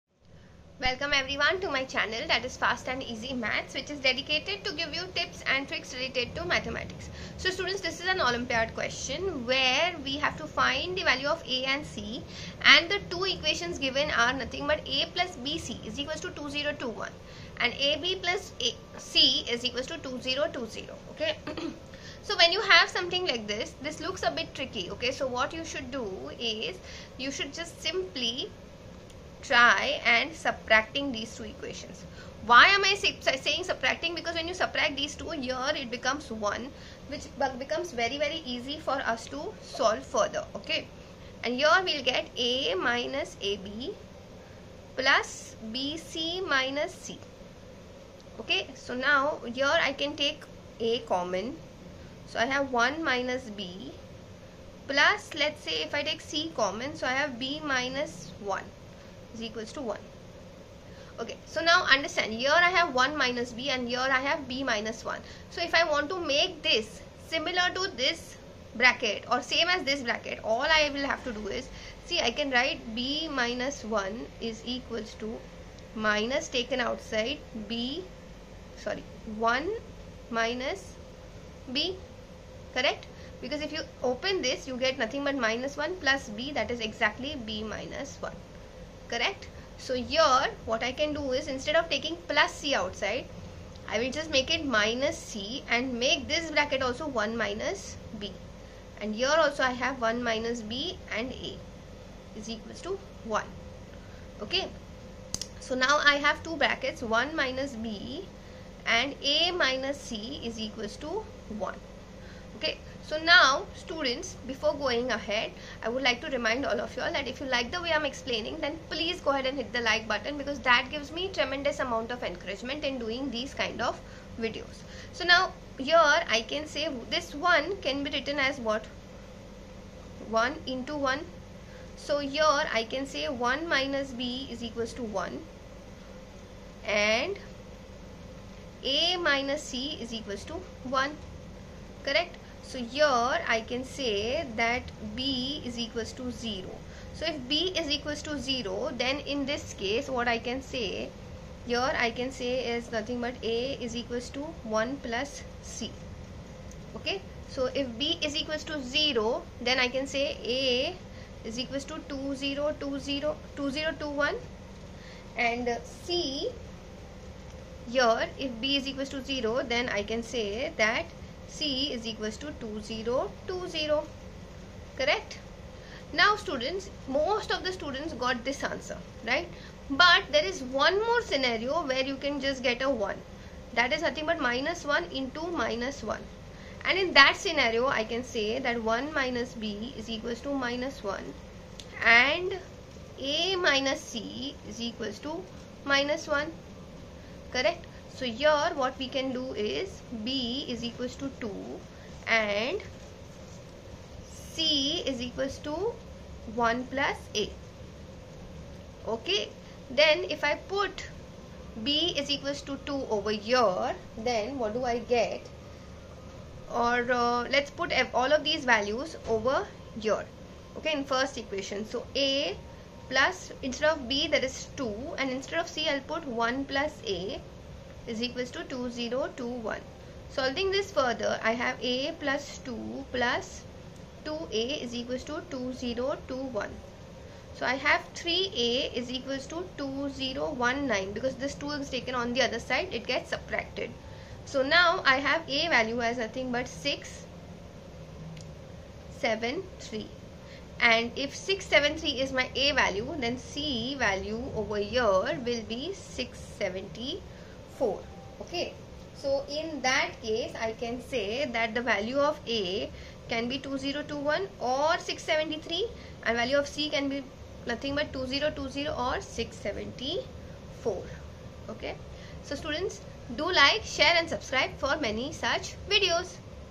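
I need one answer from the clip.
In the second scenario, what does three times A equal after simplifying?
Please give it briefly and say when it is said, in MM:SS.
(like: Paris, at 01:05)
2019, at 03:59.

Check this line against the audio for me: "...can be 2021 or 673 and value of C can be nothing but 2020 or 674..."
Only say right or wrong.
right.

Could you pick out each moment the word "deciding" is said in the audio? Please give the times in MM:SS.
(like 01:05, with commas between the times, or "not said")
not said.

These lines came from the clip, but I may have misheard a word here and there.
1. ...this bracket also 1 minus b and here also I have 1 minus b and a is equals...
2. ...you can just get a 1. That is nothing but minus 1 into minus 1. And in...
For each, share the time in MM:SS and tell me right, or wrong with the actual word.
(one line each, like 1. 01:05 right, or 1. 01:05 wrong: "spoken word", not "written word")
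1. 01:36 right
2. 03:02 right.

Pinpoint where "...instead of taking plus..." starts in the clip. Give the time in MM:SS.
01:31.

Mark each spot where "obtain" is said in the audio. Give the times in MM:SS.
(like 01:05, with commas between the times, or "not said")
not said.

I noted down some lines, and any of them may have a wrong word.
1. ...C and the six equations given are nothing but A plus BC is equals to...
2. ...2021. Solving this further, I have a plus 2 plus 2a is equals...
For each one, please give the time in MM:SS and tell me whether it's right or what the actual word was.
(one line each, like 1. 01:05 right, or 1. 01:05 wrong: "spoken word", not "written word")
1. 00:11 wrong: "two", not "six"
2. 03:48 right.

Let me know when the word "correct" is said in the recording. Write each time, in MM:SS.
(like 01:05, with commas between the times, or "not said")
01:22, 01:29, 02:22, 02:54, 03:17.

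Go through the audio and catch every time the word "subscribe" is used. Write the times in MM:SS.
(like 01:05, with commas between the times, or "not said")
04:34.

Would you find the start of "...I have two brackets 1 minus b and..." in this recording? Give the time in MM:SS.
01:46.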